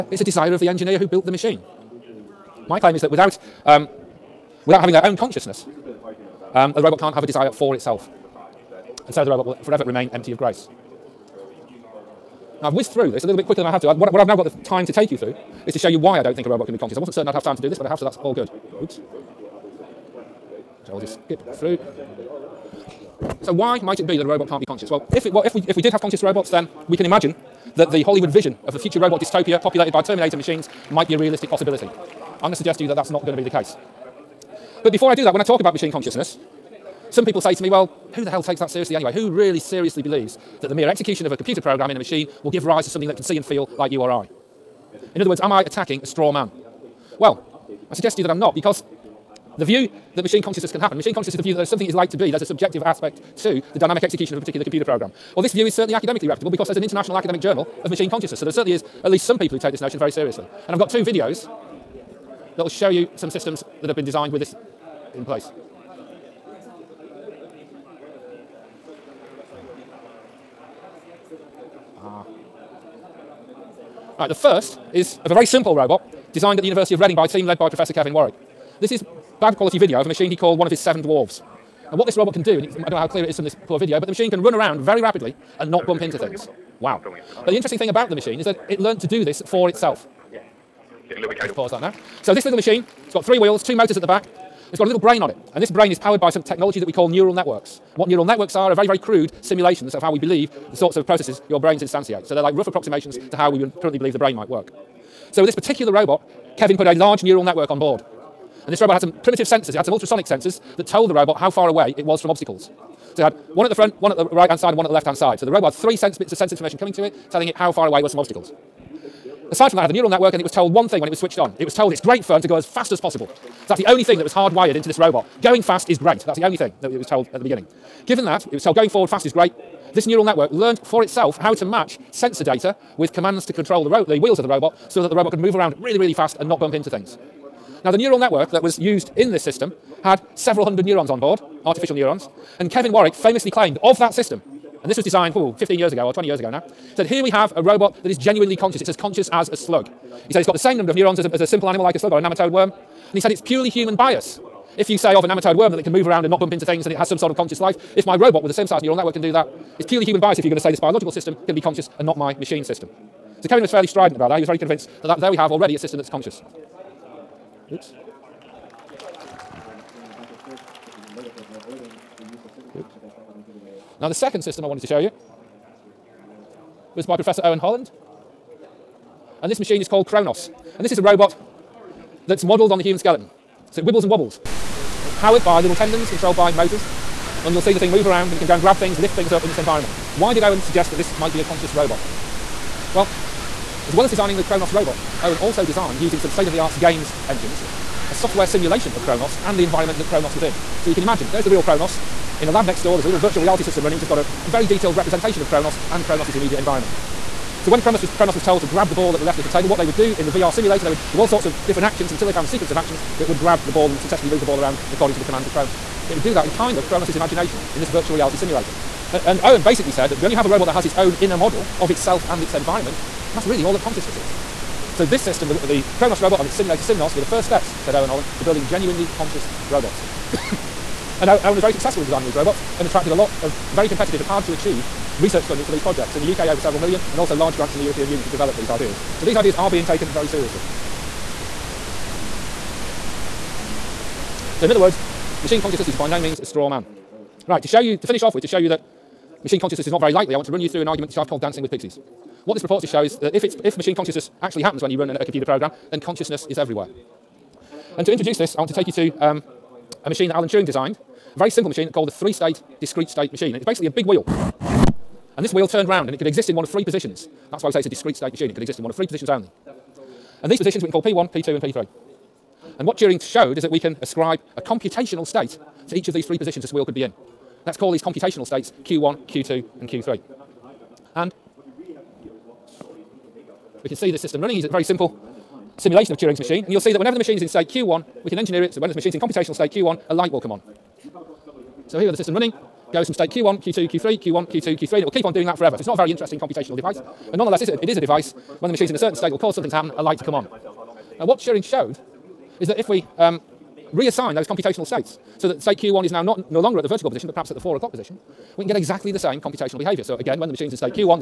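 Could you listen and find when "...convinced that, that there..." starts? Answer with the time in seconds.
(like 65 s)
164 s.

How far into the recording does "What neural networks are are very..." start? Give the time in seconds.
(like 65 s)
97 s.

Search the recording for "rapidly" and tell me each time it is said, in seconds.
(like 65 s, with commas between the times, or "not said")
85 s.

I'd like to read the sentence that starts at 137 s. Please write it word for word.
Now, the neural network that was used in this system had several hundred neurons on board, artificial neurons.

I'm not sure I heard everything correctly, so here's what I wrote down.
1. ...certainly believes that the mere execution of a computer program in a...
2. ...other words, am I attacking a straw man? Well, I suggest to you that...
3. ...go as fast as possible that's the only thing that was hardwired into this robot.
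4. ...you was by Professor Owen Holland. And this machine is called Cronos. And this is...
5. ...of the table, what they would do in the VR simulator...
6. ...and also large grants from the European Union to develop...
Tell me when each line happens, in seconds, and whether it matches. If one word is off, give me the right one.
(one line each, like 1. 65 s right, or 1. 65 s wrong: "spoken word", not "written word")
1. 39 s wrong: "seriously", not "certainly"
2. 45 s right
3. 122 s right
4. 174 s right
5. 209 s right
6. 237 s right.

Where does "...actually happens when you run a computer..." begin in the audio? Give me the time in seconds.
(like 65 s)
254 s.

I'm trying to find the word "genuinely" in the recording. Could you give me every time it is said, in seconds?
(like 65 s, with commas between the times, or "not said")
148 s, 228 s.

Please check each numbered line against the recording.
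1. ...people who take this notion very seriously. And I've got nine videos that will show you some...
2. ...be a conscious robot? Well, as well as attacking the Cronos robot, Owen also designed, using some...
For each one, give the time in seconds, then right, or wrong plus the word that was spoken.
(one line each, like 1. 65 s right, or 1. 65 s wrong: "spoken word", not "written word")
1. 59 s wrong: "two", not "nine"
2. 191 s wrong: "designing", not "attacking".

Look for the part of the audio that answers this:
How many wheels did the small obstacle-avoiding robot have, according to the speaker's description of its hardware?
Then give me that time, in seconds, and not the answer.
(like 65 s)
93 s.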